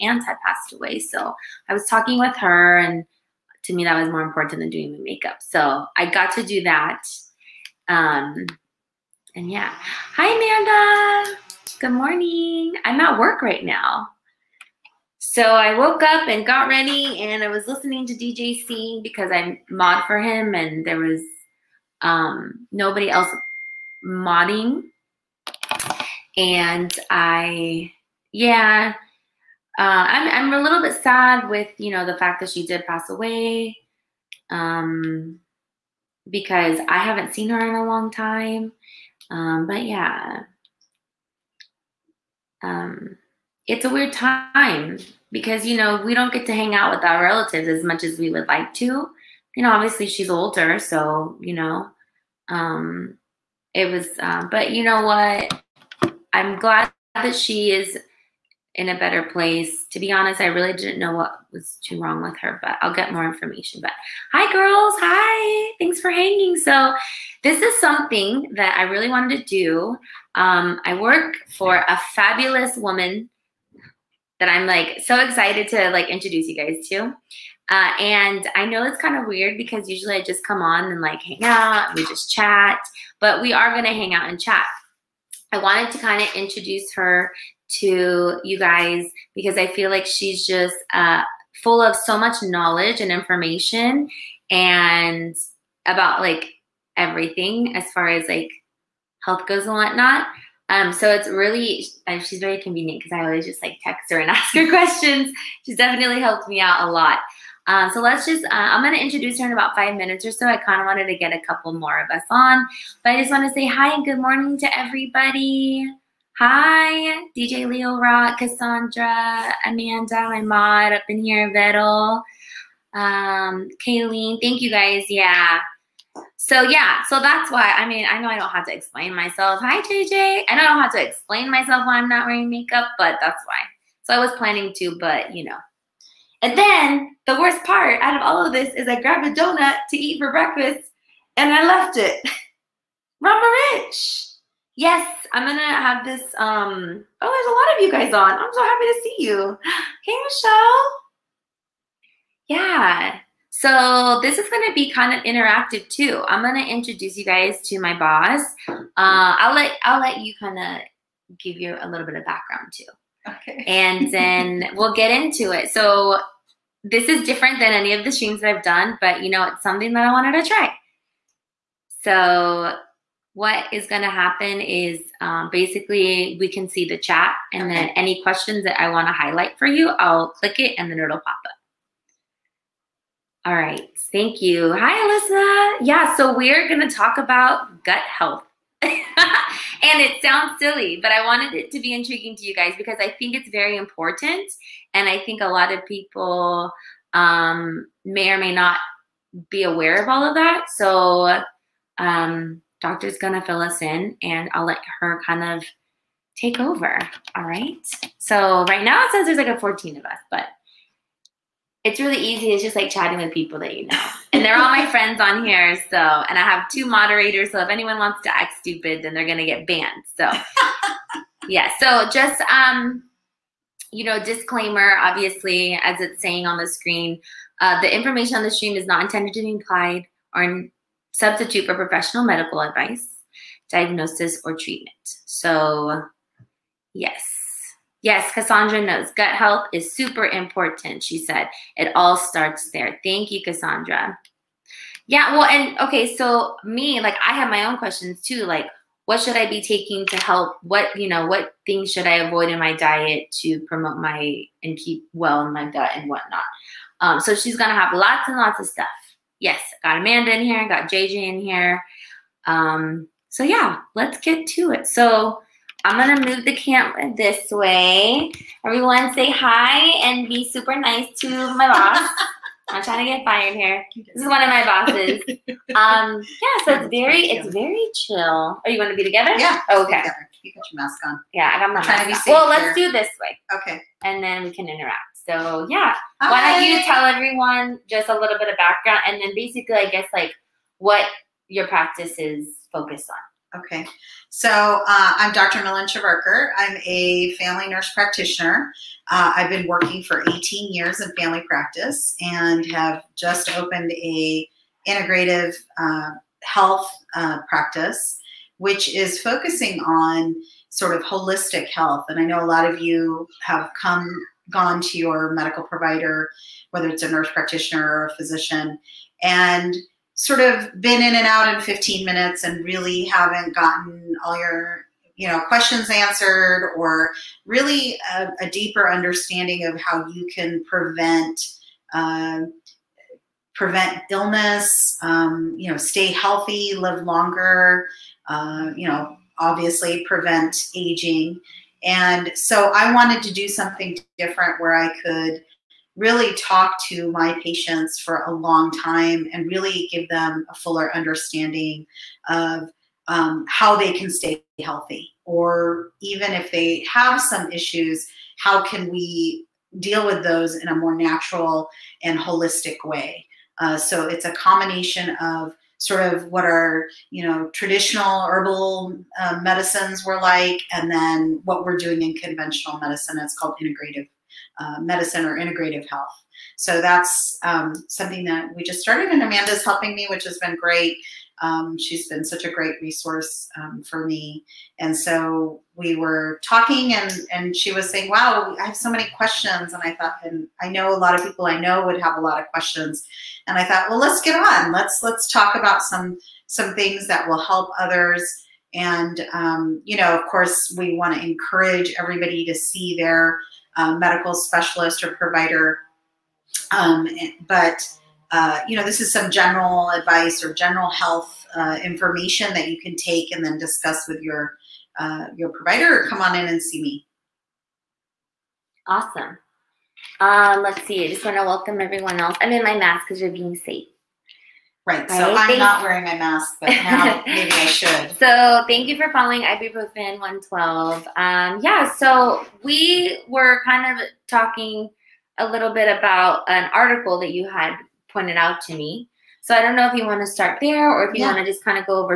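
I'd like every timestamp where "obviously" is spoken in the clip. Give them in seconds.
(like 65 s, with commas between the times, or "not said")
49 s, 225 s, 339 s.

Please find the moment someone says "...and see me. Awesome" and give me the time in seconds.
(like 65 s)
416 s.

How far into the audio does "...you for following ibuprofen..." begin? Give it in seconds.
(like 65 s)
428 s.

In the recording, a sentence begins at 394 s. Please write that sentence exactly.
Let's let's talk about some some things that will help others.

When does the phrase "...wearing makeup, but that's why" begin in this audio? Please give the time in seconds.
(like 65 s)
132 s.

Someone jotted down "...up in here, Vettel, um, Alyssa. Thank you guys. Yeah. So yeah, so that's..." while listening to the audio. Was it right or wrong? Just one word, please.
wrong.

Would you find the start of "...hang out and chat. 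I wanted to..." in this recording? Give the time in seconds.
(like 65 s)
83 s.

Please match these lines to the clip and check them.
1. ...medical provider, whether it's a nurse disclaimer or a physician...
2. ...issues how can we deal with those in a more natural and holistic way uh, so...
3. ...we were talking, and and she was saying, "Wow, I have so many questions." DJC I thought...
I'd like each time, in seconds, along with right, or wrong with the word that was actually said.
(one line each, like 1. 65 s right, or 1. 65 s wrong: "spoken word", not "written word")
1. 315 s wrong: "practitioner", not "disclaimer"
2. 357 s right
3. 385 s wrong: "And", not "DJC".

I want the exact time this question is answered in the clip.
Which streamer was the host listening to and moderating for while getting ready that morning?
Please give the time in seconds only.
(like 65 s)
18 s.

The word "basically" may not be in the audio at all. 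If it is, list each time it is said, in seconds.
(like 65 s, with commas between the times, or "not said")
175 s, 289 s.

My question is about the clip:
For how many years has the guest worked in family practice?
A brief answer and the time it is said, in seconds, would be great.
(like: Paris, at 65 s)
18, at 300 s.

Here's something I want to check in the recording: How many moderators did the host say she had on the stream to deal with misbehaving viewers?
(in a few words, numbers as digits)
2.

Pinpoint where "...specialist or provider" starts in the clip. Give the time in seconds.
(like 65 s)
404 s.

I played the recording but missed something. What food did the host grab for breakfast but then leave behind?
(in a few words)
A donut.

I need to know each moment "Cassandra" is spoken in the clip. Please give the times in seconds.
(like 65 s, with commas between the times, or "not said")
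118 s, 238 s, 243 s.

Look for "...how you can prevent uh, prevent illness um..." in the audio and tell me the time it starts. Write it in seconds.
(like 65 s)
329 s.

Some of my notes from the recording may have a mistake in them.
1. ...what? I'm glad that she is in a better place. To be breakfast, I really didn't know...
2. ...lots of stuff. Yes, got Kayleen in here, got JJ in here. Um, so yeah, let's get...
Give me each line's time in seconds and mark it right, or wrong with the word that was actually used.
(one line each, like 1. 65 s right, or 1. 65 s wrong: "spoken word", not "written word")
1. 55 s wrong: "honest", not "breakfast"
2. 258 s wrong: "Amanda", not "Kayleen".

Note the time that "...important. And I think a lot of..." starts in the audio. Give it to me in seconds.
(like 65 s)
193 s.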